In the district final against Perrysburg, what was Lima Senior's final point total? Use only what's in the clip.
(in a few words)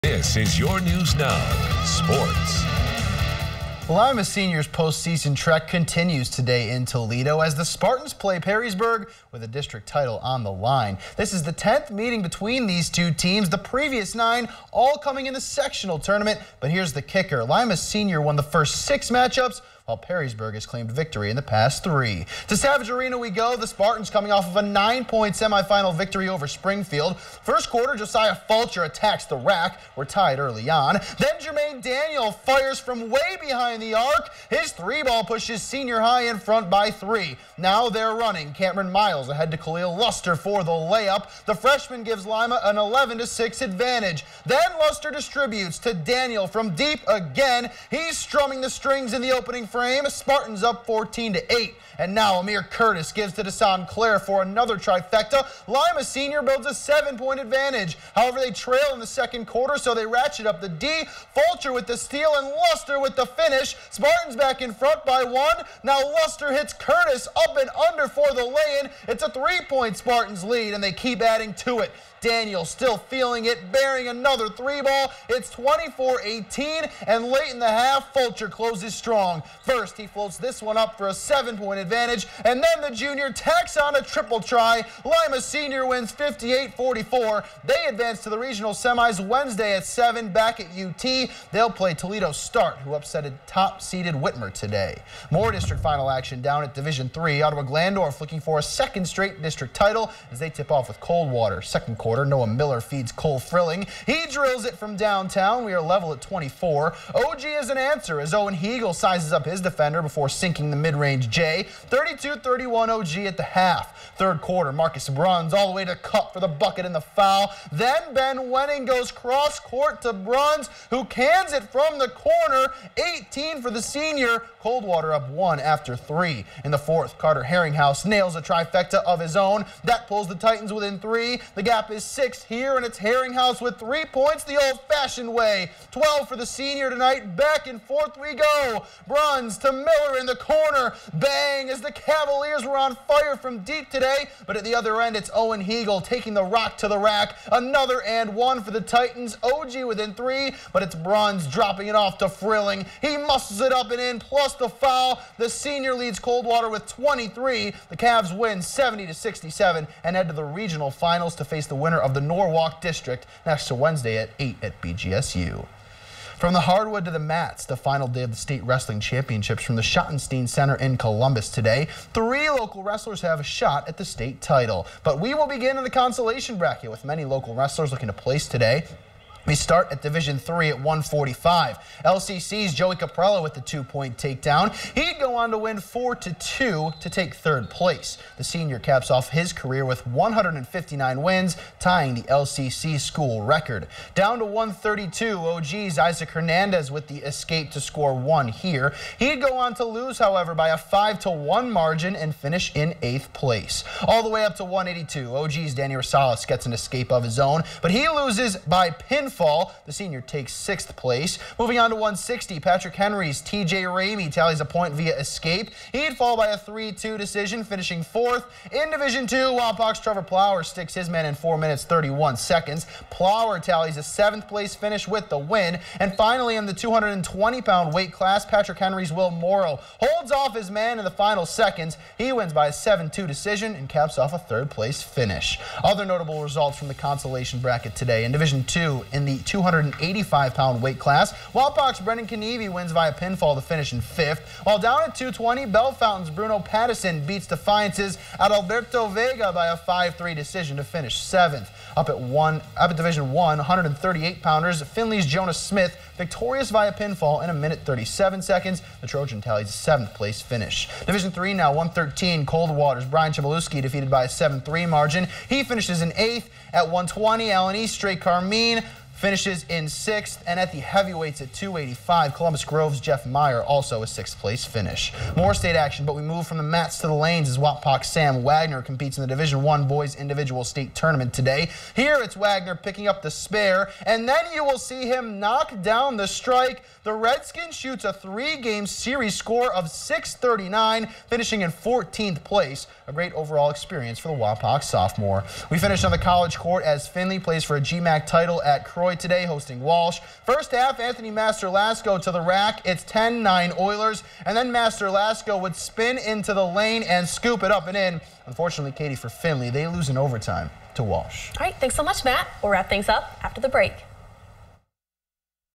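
58.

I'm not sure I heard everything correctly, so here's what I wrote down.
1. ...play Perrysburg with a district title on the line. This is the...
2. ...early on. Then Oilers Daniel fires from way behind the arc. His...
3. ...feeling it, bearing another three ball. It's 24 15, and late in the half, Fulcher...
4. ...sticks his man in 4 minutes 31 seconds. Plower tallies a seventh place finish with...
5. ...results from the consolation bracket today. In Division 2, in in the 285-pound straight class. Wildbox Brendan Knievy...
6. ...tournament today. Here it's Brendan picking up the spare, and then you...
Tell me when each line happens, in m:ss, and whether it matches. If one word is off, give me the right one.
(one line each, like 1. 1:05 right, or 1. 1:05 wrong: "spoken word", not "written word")
1. 0:08 right
2. 0:30 wrong: "Jermaine", not "Oilers"
3. 1:12 wrong: "18", not "15"
4. 3:40 right
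5. 3:56 wrong: "weight", not "straight"
6. 4:40 wrong: "Wagner", not "Brendan".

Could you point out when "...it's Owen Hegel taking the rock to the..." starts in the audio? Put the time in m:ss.
2:25.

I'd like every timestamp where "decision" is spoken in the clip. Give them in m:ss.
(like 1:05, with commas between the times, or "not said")
3:37, 3:53, 4:10.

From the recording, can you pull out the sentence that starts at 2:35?
The senior leads Coldwater with 23.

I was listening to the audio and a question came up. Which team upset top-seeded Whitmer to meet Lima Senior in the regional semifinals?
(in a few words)
Toledo Start.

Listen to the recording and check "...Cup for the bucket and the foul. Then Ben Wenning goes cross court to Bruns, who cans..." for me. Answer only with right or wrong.
right.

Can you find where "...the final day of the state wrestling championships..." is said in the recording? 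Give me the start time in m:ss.
2:47.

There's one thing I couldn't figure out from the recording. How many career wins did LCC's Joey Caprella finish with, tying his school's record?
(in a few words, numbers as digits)
159.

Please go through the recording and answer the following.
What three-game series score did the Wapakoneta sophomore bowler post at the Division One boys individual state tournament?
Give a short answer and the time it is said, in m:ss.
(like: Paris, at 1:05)
639, at 4:49.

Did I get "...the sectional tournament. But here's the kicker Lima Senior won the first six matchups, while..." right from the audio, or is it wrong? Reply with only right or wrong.
right.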